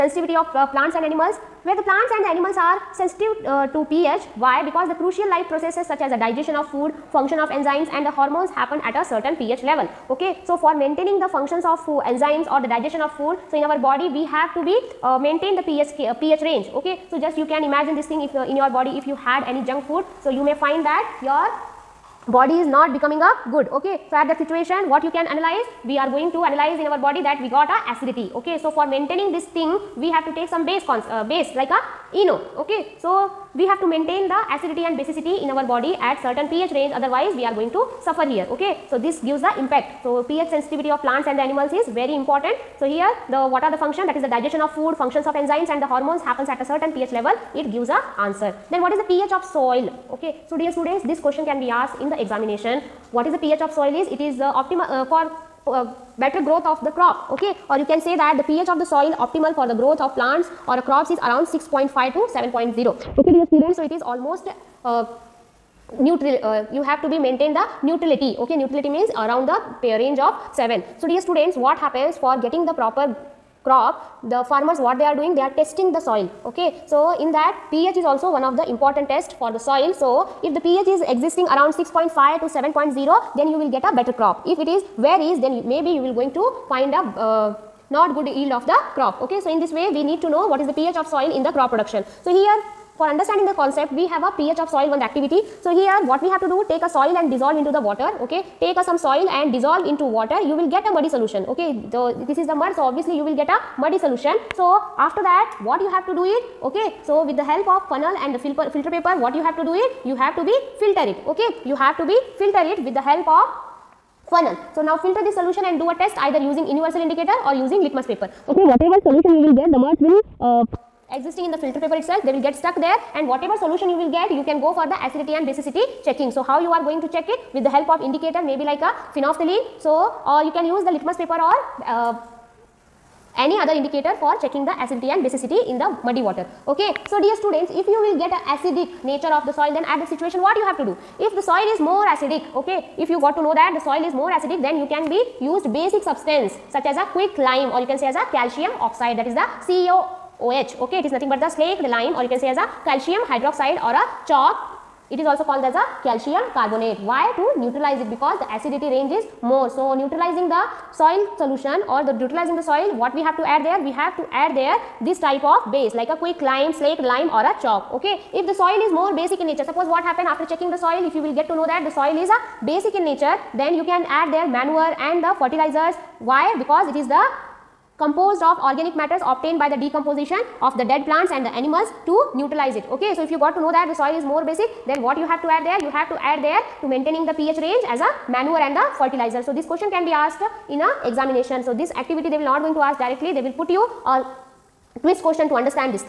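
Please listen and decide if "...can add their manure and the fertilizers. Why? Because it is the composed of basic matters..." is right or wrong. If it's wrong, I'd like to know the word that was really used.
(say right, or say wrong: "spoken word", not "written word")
wrong: "organic", not "basic".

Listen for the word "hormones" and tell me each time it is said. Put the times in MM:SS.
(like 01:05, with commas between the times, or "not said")
00:08, 00:45.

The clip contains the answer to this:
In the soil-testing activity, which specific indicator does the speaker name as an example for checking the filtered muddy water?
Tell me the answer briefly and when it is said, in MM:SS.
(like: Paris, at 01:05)
Phenolphthalein, at 02:09.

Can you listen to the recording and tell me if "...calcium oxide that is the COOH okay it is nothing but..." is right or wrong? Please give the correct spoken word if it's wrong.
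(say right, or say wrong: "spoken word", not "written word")
right.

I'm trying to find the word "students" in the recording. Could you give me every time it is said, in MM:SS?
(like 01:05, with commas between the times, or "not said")
00:50, 01:03, 01:11, 02:17.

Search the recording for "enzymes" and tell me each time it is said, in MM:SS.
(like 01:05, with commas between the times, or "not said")
00:07, 00:12, 00:45.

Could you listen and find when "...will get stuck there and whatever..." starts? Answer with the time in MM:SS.
02:02.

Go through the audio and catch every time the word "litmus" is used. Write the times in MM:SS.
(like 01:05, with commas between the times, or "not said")
01:57, 02:10.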